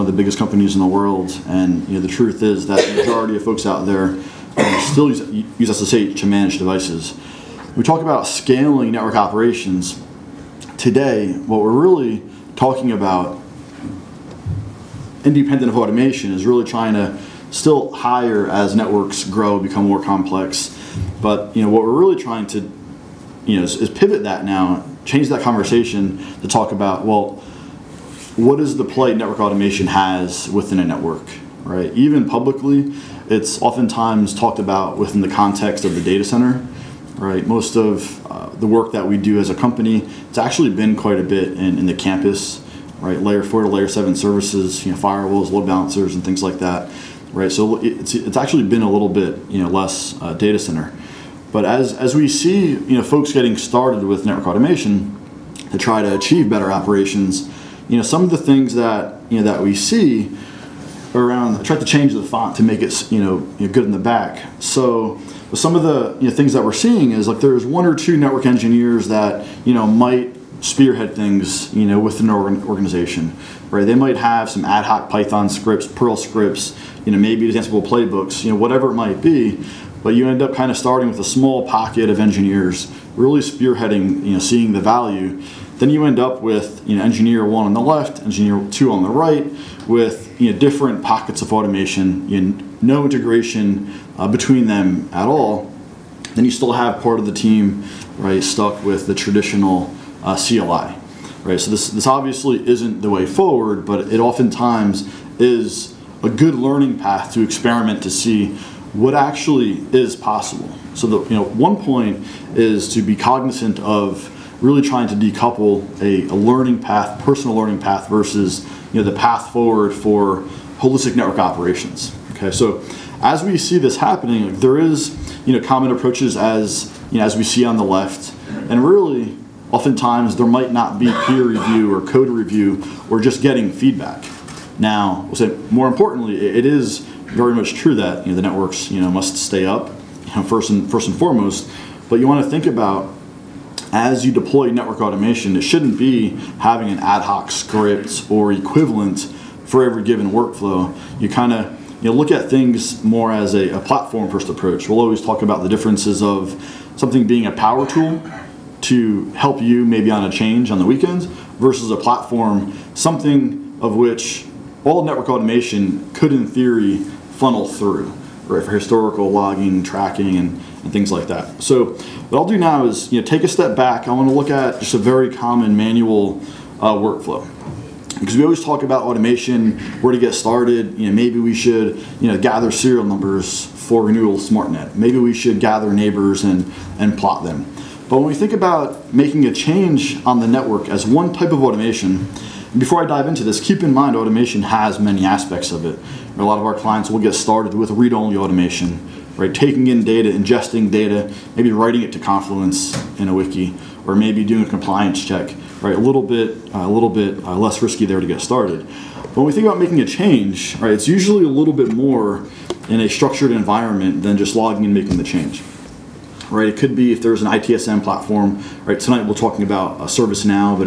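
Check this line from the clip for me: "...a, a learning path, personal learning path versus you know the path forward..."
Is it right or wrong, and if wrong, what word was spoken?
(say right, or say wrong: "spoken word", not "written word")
right.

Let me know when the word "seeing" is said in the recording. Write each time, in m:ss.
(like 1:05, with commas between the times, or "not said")
1:06, 1:24.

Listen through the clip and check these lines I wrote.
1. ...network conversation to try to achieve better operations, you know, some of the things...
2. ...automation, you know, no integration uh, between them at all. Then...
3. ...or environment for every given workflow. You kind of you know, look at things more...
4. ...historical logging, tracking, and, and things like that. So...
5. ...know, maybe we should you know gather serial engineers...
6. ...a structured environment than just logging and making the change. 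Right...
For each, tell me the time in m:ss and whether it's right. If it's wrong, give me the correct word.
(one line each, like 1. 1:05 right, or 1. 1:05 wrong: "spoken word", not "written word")
1. 0:54 wrong: "automation", not "conversation"
2. 1:31 right
3. 2:28 wrong: "equivalent", not "environment"
4. 2:48 right
5. 3:01 wrong: "numbers", not "engineers"
6. 3:33 right.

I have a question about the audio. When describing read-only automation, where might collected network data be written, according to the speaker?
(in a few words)
Confluence.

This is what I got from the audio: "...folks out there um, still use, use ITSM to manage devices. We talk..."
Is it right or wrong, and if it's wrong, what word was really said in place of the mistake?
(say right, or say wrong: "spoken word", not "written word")
wrong: "SSH", not "ITSM".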